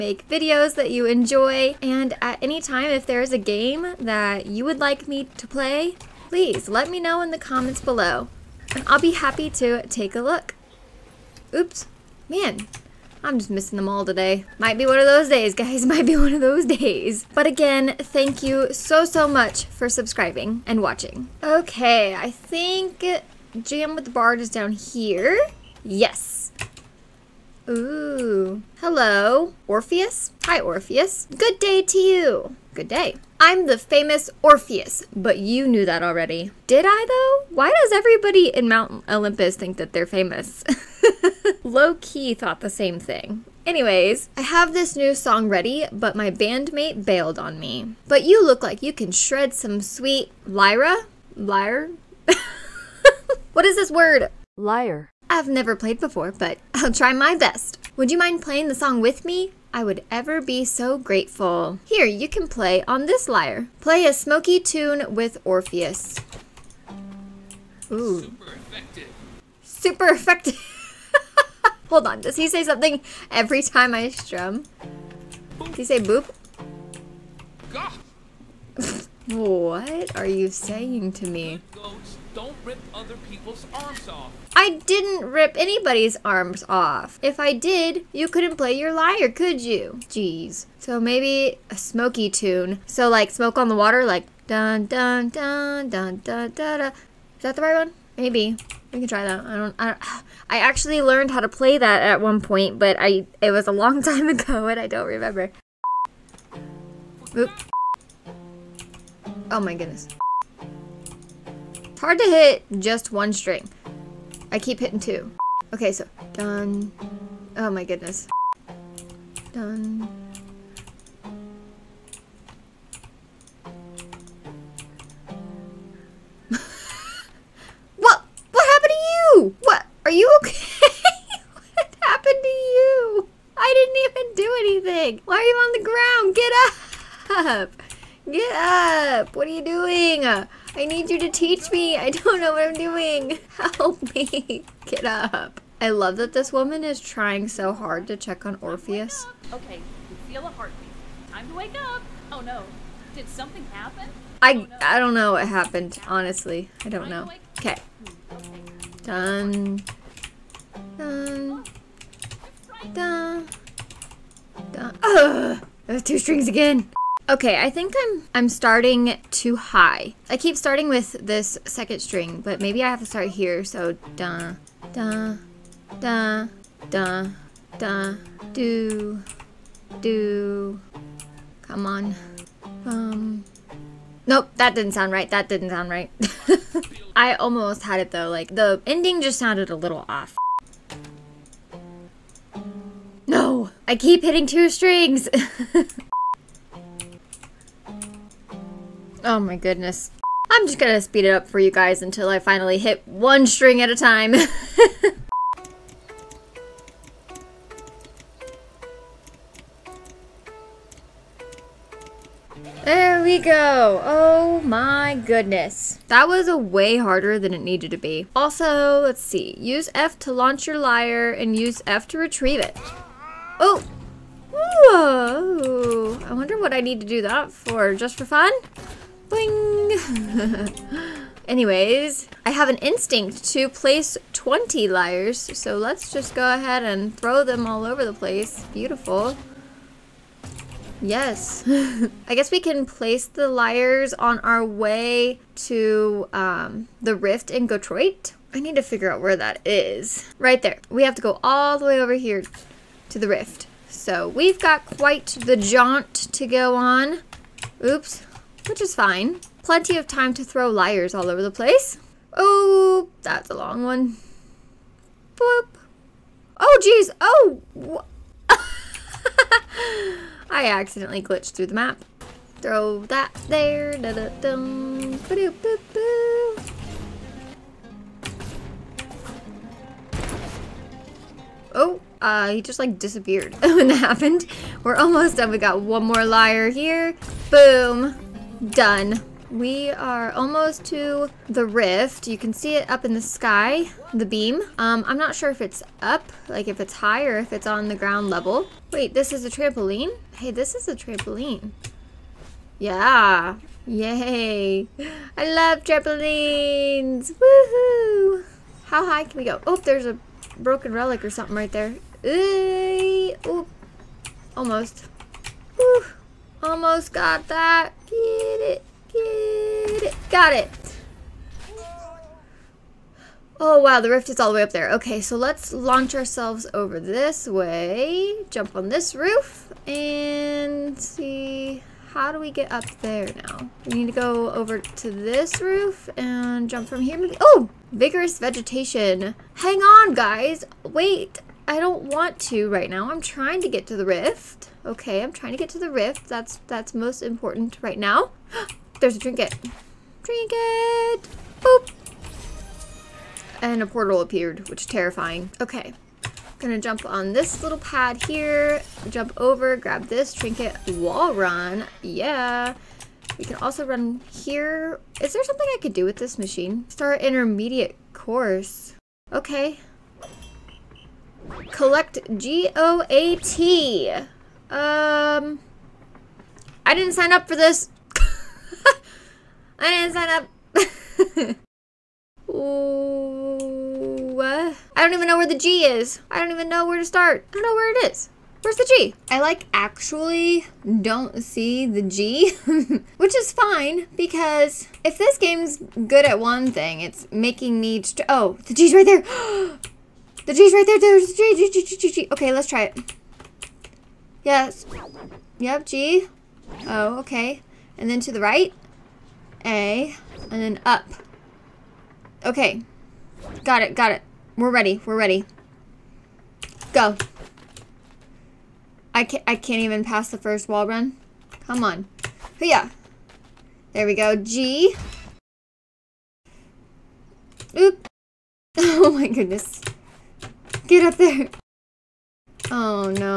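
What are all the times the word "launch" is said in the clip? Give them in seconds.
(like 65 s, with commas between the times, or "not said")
220 s, 325 s.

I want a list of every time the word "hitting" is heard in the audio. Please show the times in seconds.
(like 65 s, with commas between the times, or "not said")
114 s, 194 s.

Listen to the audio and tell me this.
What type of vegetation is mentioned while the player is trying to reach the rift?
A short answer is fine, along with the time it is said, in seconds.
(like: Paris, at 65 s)
Vigorous vegetation, at 337 s.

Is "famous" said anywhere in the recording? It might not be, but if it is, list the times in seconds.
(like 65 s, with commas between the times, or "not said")
33 s, 40 s.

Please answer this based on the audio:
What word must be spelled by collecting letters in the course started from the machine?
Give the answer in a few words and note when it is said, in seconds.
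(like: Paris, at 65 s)
GOAT, at 372 s.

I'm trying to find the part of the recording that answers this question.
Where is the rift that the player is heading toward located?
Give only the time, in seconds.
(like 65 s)
247 s.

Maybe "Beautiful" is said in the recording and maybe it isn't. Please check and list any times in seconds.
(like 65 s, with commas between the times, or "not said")
238 s.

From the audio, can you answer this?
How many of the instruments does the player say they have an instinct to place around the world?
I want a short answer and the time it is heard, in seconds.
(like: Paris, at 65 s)
20, at 234 s.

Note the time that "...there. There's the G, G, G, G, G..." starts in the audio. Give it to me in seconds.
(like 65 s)
400 s.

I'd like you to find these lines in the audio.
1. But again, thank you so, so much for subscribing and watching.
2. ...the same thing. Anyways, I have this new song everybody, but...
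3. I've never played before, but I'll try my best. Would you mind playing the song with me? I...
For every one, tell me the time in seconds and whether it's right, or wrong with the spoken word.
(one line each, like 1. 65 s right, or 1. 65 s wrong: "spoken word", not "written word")
1. 17 s right
2. 42 s wrong: "ready", not "everybody"
3. 55 s right.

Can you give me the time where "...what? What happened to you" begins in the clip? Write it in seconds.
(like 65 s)
127 s.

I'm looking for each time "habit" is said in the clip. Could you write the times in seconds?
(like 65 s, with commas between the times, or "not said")
not said.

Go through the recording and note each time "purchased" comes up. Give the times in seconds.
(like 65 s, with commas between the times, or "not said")
not said.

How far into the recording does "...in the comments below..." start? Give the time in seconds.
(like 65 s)
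7 s.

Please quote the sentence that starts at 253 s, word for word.
So we've got quite the jaunt to go on.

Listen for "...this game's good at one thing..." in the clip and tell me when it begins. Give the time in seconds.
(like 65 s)
395 s.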